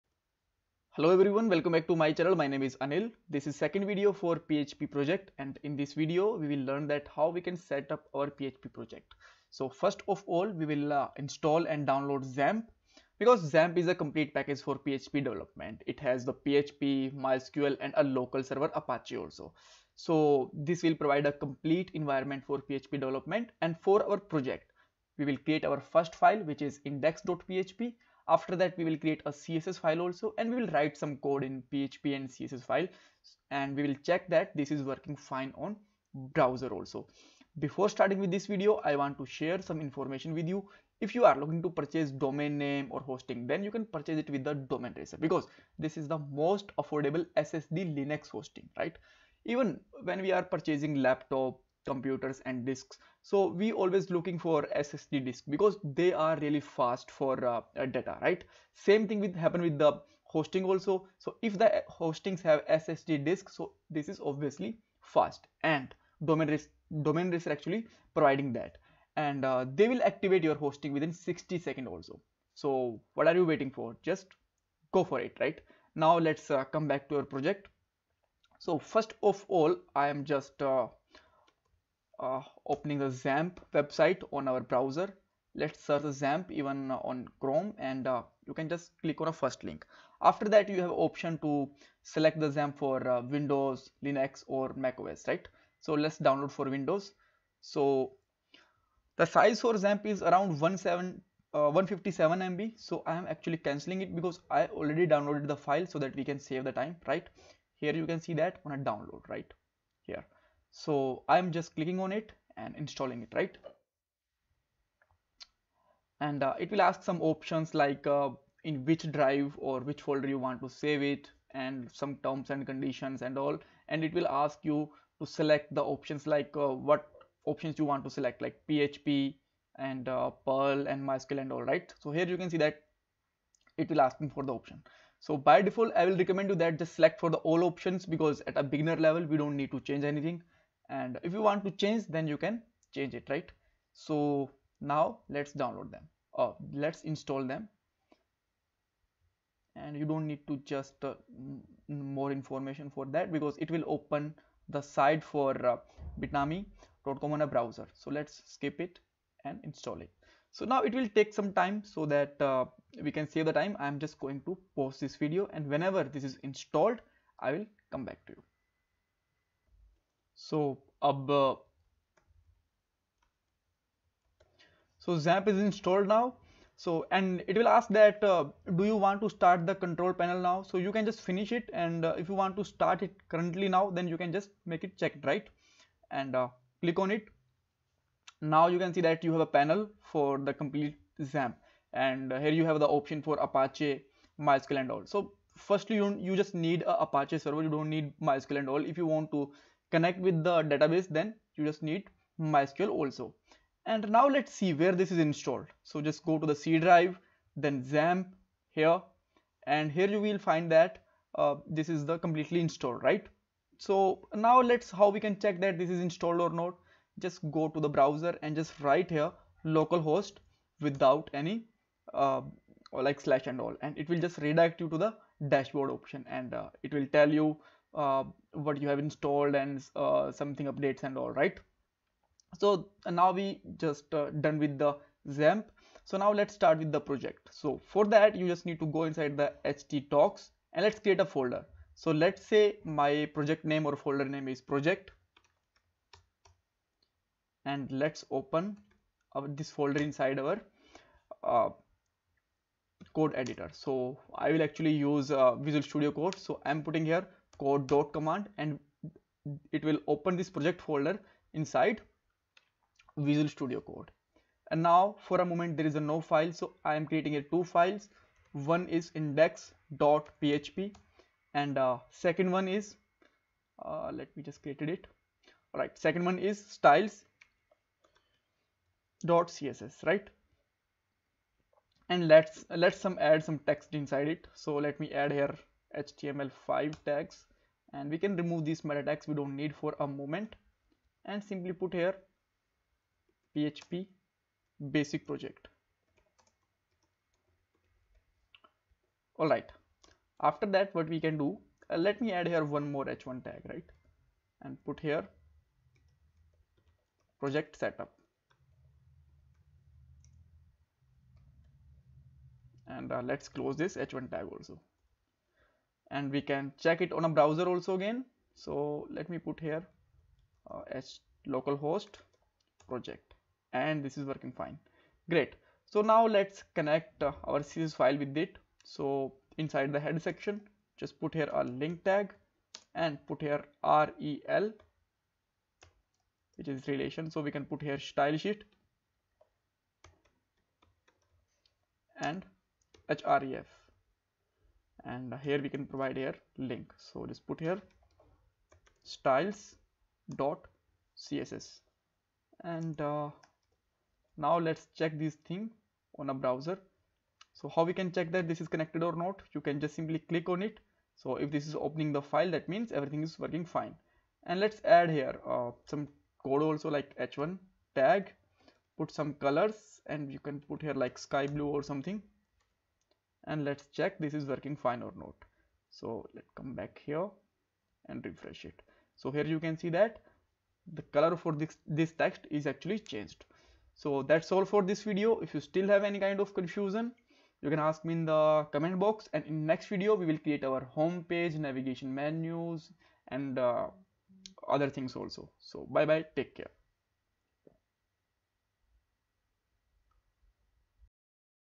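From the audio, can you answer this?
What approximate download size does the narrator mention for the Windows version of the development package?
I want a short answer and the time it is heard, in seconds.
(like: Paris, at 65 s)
157 MB, at 101 s.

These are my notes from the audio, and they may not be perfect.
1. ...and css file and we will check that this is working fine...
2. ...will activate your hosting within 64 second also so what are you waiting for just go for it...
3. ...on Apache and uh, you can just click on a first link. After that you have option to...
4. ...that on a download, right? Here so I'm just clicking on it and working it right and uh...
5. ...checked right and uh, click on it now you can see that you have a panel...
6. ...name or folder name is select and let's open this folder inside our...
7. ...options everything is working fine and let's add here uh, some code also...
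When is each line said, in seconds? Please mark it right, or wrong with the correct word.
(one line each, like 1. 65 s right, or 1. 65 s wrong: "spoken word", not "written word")
1. 32 s right
2. 69 s wrong: "60", not "64"
3. 86 s wrong: "Chrome", not "Apache"
4. 108 s wrong: "installing", not "working"
5. 185 s right
6. 243 s wrong: "project", not "select"
7. 362 s wrong: "means", not "options".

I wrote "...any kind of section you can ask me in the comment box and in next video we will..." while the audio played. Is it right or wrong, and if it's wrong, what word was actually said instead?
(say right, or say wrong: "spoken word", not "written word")
wrong: "confusion", not "section".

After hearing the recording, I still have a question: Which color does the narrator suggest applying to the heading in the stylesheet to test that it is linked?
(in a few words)
sky blue.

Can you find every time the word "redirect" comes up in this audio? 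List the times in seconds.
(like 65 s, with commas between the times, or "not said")
224 s.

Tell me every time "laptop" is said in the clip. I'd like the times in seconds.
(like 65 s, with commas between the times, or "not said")
51 s.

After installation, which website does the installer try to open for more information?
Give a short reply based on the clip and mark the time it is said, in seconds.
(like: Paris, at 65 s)
bitnami.com, at 156 s.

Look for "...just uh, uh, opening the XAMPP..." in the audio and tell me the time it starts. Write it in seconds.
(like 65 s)
80 s.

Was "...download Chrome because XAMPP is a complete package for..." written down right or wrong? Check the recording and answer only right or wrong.
wrong.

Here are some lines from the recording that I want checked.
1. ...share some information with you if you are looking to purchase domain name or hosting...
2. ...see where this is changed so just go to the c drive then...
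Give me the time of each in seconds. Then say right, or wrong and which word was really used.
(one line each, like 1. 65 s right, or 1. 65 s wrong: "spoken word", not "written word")
1. 39 s right
2. 204 s wrong: "installed", not "changed".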